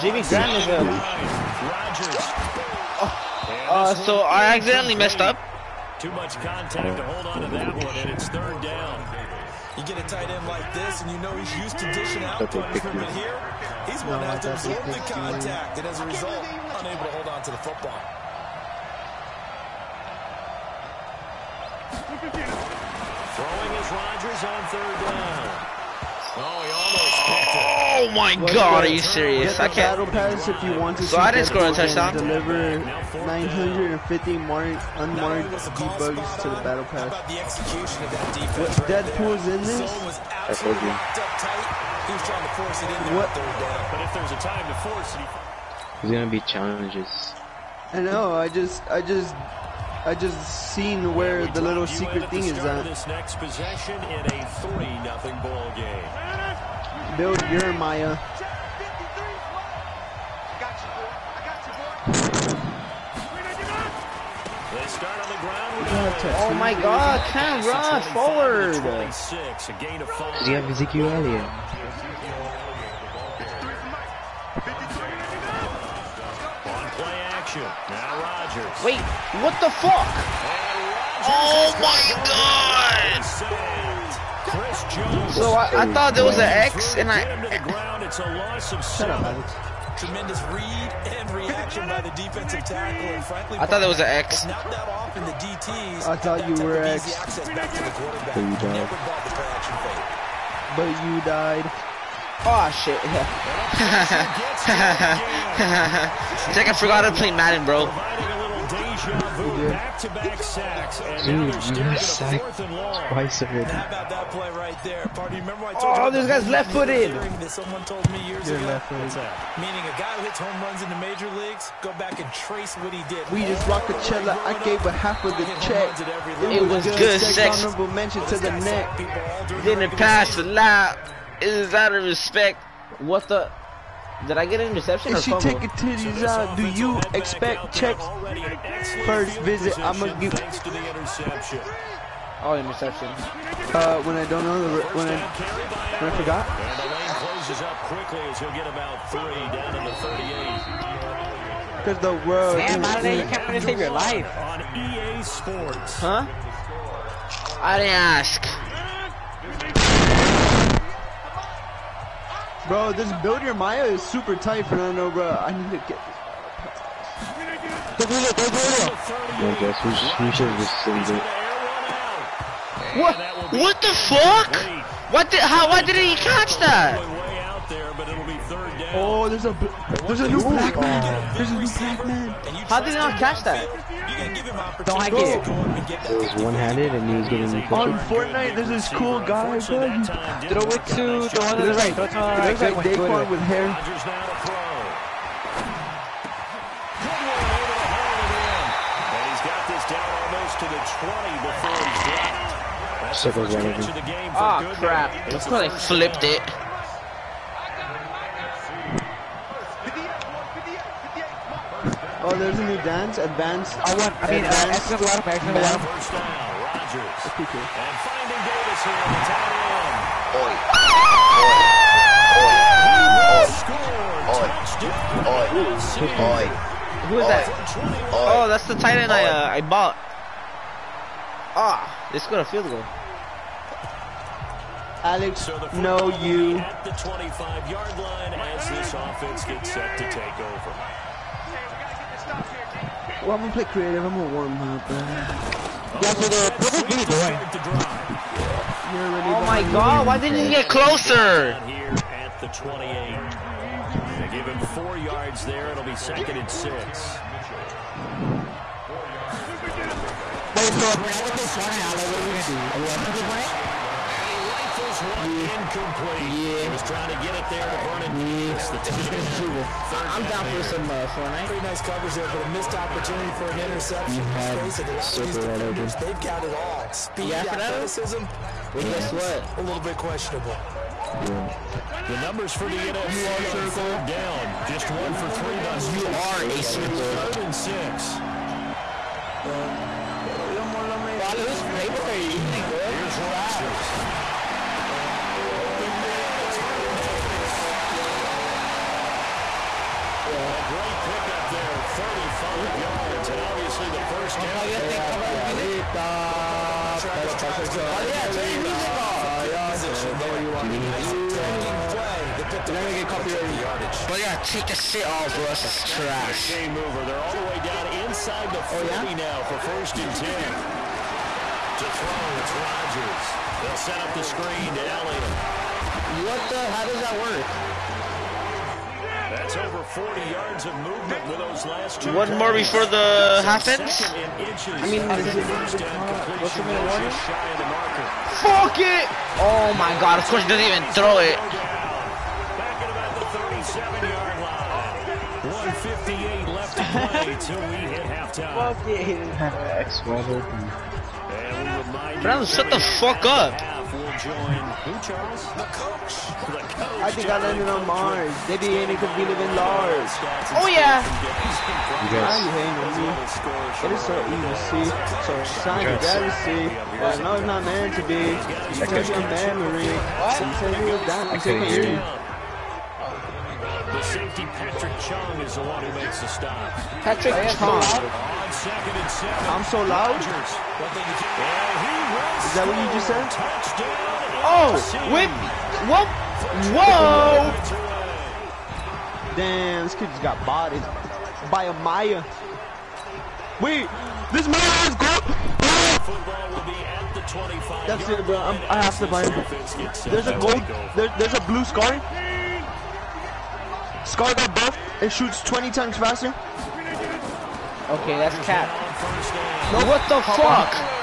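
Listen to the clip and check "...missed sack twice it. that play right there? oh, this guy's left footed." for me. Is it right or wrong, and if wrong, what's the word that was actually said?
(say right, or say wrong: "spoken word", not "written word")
right.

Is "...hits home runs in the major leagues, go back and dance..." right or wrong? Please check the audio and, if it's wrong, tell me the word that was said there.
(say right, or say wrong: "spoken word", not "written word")
wrong: "trace", not "dance".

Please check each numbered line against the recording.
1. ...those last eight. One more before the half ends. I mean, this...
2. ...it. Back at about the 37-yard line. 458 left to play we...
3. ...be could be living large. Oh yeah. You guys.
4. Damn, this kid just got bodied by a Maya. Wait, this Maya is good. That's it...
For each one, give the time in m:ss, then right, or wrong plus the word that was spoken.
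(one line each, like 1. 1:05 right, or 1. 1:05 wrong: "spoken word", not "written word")
1. 5:31 wrong: "two", not "eight"
2. 5:41 wrong: "158", not "458"
3. 5:58 right
4. 6:29 right.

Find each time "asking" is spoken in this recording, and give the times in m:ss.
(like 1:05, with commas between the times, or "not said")
not said.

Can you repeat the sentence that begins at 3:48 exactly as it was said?
Oh, that's the tight end I, uh, I bought.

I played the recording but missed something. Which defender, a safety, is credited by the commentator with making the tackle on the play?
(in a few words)
Patrick Chung.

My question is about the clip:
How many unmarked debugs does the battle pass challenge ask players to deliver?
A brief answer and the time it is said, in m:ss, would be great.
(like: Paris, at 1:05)
950, at 0:32.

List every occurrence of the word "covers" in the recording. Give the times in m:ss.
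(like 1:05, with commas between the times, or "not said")
4:31, 5:05.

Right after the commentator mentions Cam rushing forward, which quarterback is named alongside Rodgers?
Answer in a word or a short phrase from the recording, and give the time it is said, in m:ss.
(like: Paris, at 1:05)
Minshew, at 1:17.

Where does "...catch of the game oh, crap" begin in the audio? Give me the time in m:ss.
3:23.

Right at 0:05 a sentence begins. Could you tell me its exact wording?
Too much contact to hold on to that one, and it's third down.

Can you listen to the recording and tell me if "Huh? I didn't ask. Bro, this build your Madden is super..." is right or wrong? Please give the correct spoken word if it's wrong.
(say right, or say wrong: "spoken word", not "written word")
wrong: "Maya", not "Madden".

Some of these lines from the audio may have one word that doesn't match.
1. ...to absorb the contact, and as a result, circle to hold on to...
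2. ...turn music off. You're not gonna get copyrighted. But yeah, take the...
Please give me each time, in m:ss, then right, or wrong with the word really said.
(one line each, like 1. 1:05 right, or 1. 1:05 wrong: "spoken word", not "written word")
1. 0:14 wrong: "unable", not "circle"
2. 5:08 right.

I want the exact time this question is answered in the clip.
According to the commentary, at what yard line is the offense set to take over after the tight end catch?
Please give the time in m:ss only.
3:56.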